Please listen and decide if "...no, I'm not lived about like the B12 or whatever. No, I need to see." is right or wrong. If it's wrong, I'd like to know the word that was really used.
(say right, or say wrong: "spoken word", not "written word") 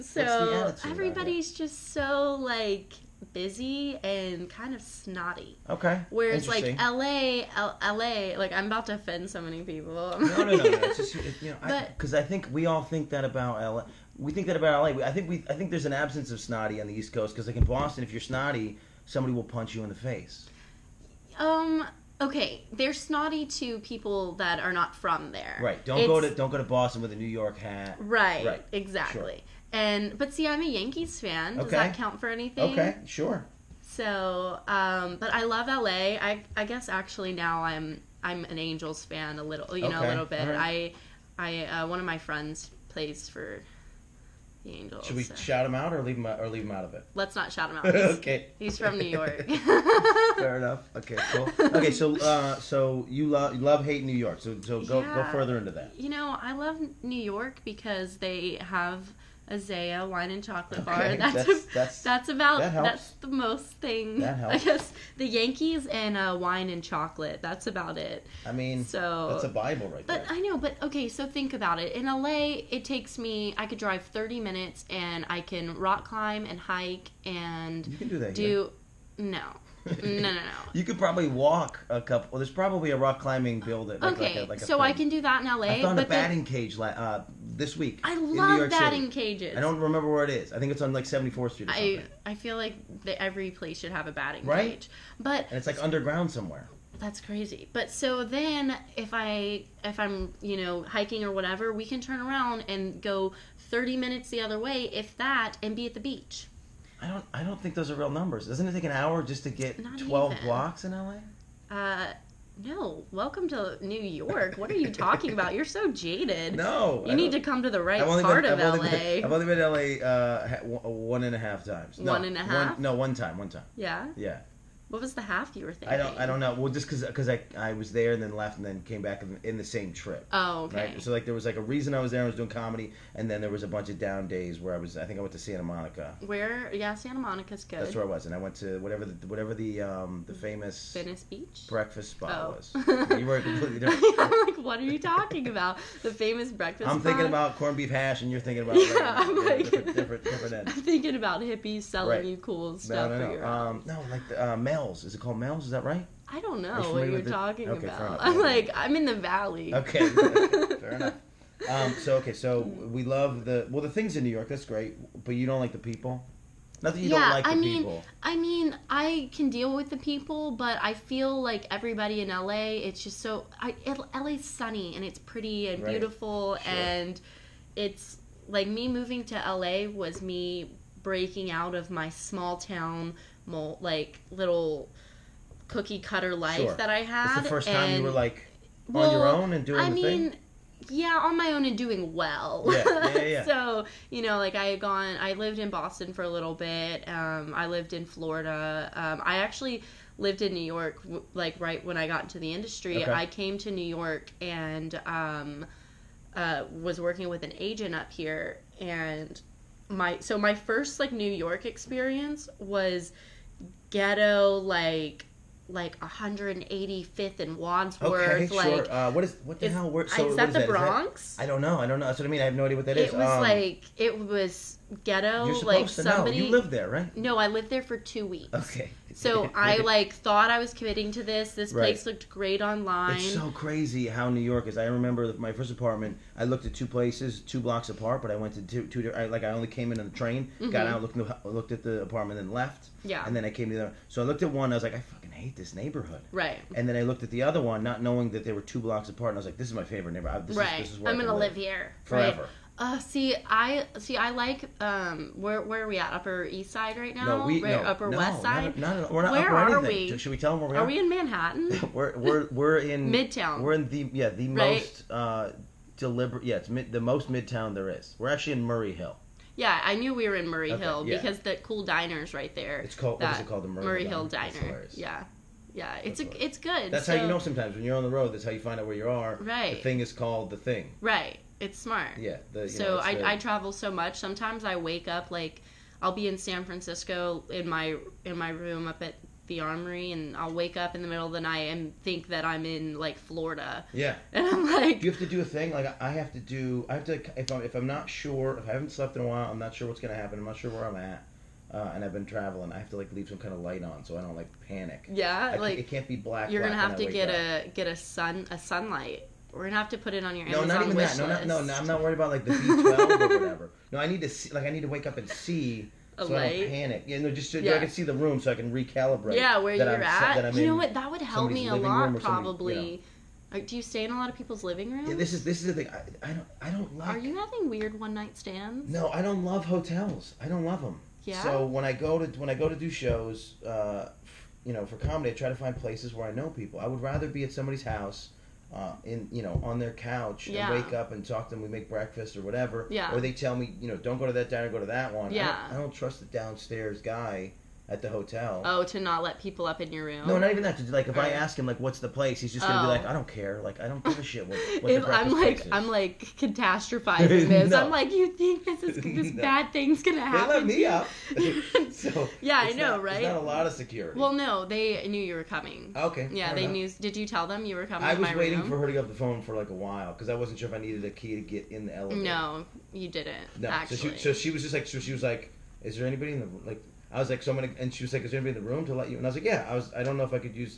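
wrong: "worried", not "lived".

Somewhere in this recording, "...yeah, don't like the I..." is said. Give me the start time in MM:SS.
02:47.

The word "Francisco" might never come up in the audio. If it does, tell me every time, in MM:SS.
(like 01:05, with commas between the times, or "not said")
04:46.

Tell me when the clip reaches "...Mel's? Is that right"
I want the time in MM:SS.
02:35.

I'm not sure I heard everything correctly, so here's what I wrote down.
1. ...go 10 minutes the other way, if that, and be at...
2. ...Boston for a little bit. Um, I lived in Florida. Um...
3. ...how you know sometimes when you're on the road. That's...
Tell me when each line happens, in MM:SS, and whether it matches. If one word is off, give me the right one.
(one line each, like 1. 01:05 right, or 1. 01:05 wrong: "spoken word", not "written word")
1. 01:43 wrong: "30", not "10"
2. 03:15 right
3. 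04:37 right.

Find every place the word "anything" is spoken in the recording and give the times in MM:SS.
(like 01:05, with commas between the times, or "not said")
00:32, 04:19.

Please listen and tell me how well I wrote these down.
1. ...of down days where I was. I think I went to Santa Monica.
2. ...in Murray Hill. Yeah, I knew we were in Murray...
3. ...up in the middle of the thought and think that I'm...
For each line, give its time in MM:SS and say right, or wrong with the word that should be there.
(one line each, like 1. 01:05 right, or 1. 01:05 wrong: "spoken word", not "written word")
1. 02:13 right
2. 04:28 right
3. 04:50 wrong: "night", not "thought".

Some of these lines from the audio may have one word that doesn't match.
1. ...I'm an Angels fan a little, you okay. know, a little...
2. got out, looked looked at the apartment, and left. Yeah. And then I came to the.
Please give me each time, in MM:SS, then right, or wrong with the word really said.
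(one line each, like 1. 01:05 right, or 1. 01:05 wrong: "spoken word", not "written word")
1. 00:38 right
2. 04:00 right.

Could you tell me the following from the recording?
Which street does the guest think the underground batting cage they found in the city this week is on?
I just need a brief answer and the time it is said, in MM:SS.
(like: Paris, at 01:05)
74th Street, at 01:31.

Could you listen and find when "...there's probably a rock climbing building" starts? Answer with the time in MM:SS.
01:22.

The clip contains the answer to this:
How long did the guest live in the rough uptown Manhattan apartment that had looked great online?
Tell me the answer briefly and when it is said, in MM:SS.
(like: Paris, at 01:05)
Two weeks, at 03:47.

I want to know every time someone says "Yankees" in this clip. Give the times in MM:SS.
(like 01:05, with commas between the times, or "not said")
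00:30, 01:05.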